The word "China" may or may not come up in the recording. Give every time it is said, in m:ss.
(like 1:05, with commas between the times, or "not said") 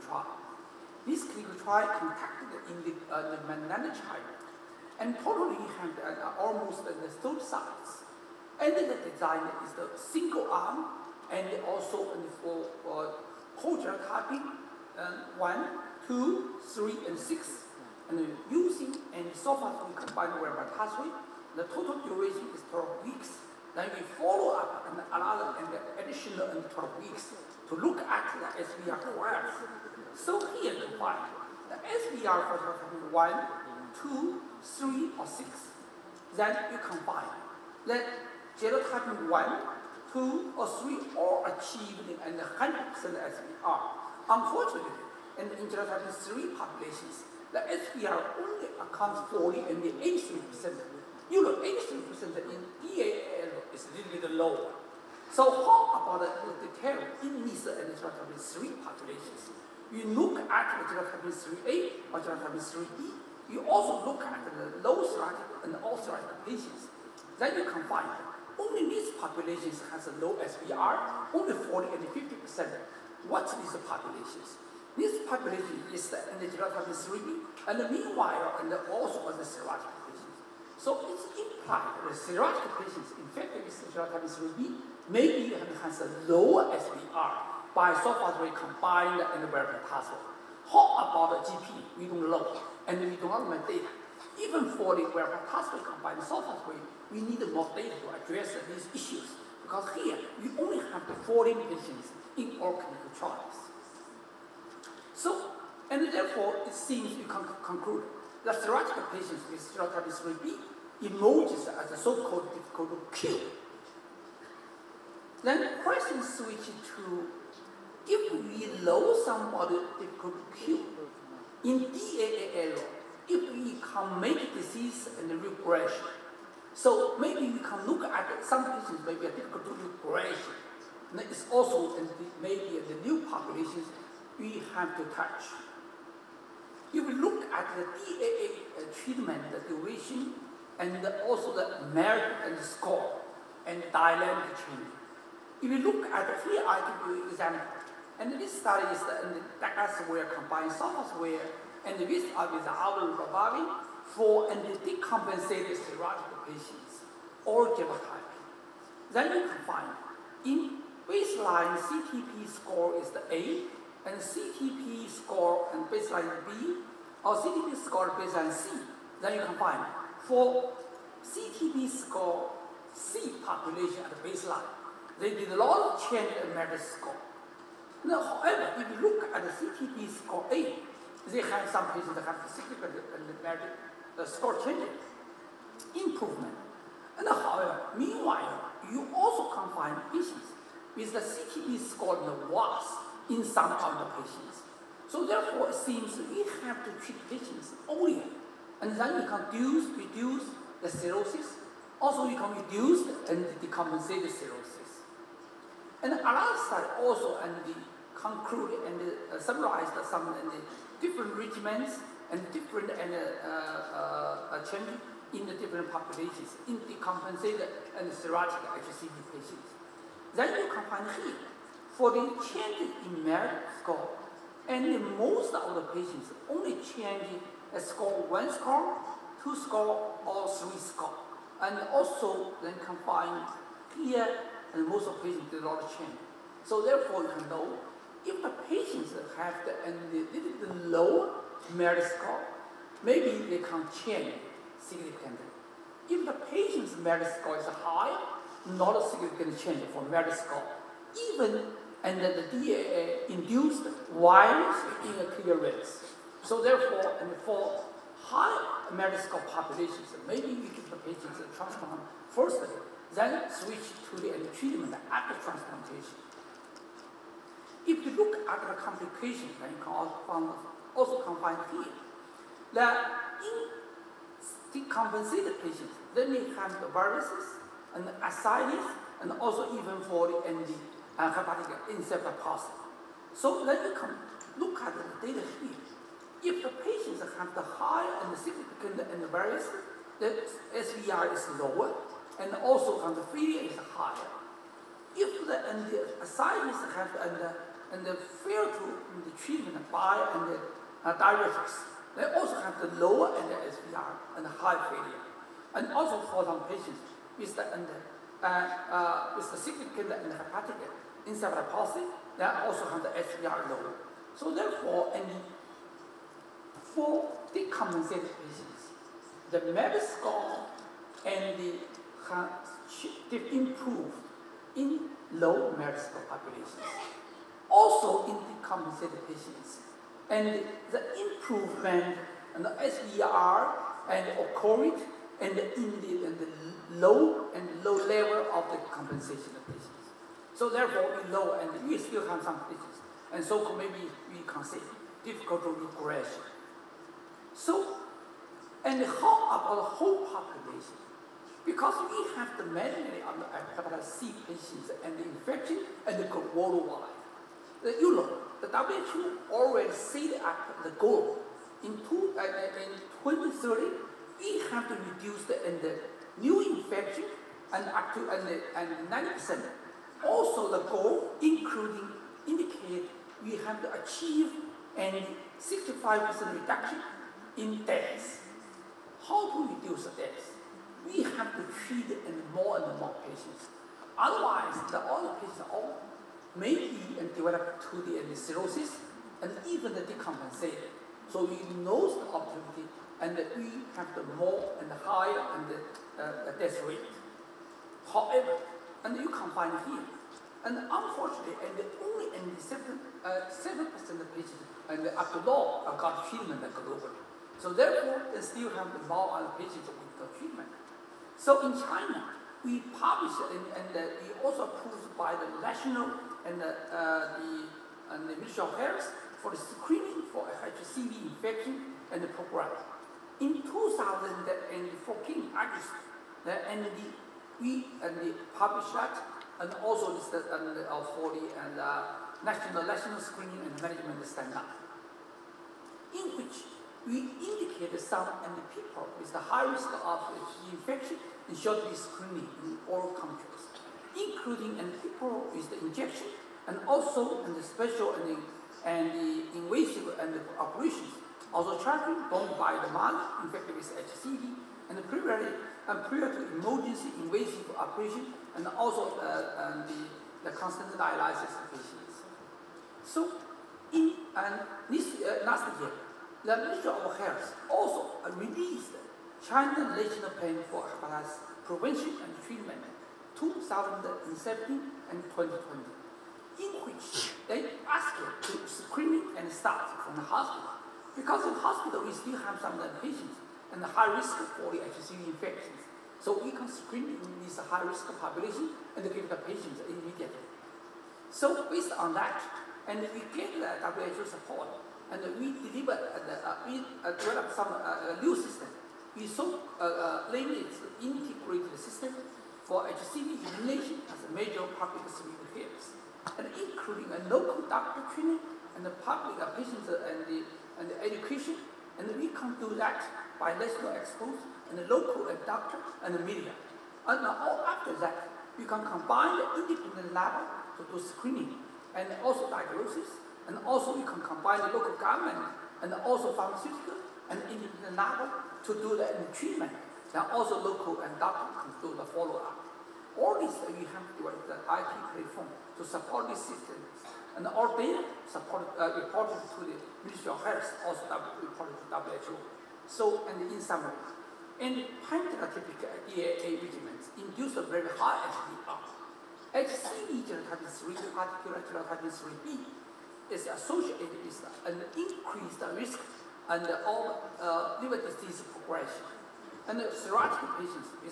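0:03, 6:51, 7:49.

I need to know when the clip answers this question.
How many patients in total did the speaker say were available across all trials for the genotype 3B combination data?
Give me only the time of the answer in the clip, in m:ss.
1:41.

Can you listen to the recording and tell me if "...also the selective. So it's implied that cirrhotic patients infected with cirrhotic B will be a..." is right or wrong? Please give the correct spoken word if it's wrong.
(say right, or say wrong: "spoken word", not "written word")
right.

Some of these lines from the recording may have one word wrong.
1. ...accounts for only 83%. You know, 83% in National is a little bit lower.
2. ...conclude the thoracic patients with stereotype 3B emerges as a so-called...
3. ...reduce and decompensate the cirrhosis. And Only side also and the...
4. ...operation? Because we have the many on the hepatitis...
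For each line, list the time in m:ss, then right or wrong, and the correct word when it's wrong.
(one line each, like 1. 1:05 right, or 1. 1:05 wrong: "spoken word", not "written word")
1. 0:48 wrong: "DAL", not "National"
2. 1:47 right
3. 3:22 wrong: "Alan", not "Only"
4. 5:50 wrong: "population", not "operation".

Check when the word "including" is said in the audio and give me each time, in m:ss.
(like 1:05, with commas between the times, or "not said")
6:11, 7:24, 8:26.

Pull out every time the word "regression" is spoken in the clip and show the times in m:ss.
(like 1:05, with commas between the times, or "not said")
2:05, 2:09, 5:45.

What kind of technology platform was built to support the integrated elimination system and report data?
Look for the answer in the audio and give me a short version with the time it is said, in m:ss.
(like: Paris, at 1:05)
IT platform, at 8:54.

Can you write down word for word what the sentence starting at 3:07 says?
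And however, meanwhile, you also can find patients with the CTP score in the worst in some of the patients.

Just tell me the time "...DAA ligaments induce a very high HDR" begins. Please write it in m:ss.
9:06.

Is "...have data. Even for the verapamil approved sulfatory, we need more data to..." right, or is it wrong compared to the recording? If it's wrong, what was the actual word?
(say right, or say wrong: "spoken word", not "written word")
wrong: "combined", not "approved".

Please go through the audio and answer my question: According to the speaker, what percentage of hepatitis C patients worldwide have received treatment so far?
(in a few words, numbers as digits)
7%.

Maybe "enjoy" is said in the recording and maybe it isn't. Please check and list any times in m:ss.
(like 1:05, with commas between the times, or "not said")
not said.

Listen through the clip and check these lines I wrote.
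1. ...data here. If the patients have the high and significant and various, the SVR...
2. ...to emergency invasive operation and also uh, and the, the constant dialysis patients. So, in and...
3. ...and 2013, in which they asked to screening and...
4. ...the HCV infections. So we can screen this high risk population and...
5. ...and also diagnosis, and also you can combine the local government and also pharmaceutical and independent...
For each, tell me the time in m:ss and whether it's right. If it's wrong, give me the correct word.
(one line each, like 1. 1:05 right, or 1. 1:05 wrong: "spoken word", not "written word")
1. 4:45 right
2. 7:36 right
3. 7:55 wrong: "2020", not "2013"
4. 8:04 right
5. 8:41 right.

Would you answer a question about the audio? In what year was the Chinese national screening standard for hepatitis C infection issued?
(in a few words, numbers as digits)
2014.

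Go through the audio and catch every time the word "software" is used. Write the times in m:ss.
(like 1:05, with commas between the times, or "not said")
2:30.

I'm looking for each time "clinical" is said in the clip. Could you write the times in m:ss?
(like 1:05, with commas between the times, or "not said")
0:01, 1:42.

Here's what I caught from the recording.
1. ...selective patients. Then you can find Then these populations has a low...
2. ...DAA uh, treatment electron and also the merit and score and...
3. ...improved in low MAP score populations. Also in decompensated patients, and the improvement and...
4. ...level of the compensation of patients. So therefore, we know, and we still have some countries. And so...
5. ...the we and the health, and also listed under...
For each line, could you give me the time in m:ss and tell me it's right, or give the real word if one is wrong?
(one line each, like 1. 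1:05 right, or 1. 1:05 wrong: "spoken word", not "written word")
1. 1:05 wrong: "Only", not "Then"
2. 2:17 wrong: "duration", not "electron"
3. 5:23 right
4. 5:38 wrong: "glitches", not "countries"
5. 7:06 right.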